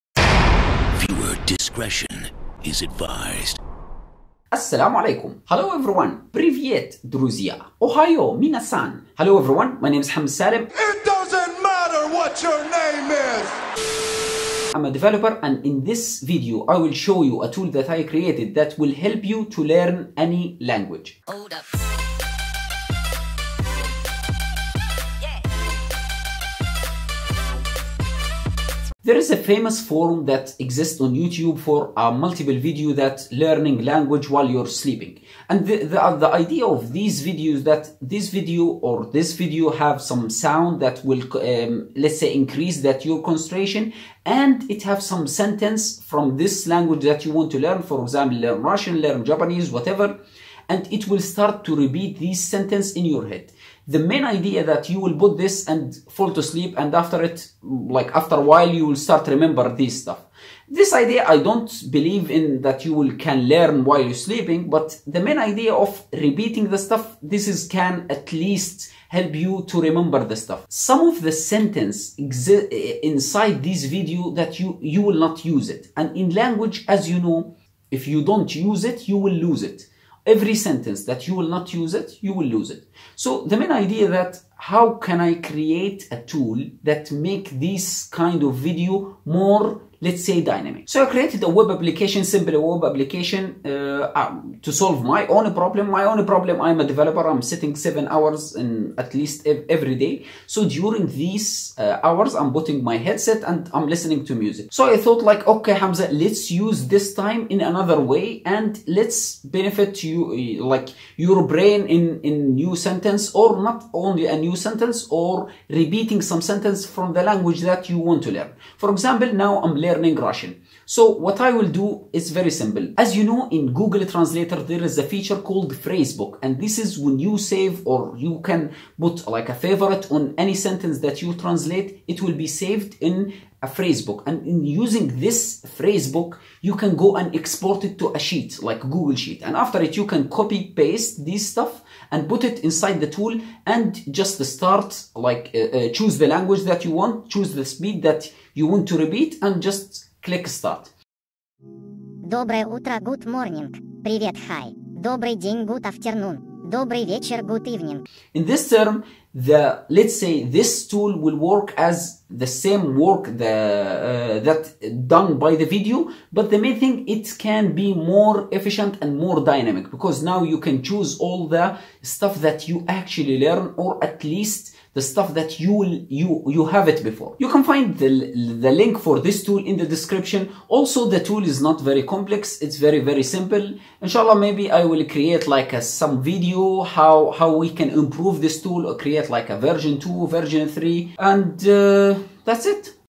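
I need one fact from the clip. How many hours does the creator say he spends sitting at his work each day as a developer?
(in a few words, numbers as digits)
7.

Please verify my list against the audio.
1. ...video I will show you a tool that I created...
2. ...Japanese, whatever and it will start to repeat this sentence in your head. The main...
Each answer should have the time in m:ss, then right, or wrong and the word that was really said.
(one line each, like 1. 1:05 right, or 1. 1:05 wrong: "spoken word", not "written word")
1. 0:16 right
2. 0:49 right.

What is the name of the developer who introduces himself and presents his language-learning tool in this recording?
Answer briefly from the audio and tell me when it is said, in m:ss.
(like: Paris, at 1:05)
Hamza Salem, at 0:10.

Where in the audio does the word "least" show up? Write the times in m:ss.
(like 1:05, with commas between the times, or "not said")
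1:08, 1:39, 2:54.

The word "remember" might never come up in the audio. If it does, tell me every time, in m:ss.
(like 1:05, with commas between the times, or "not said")
0:59, 1:09.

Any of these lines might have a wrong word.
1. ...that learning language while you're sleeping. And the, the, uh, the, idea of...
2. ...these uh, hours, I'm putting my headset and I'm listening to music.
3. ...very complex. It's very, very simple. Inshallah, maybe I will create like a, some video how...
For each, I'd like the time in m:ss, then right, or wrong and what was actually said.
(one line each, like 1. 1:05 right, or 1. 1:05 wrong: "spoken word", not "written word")
1. 0:32 right
2. 1:41 right
3. 3:01 right.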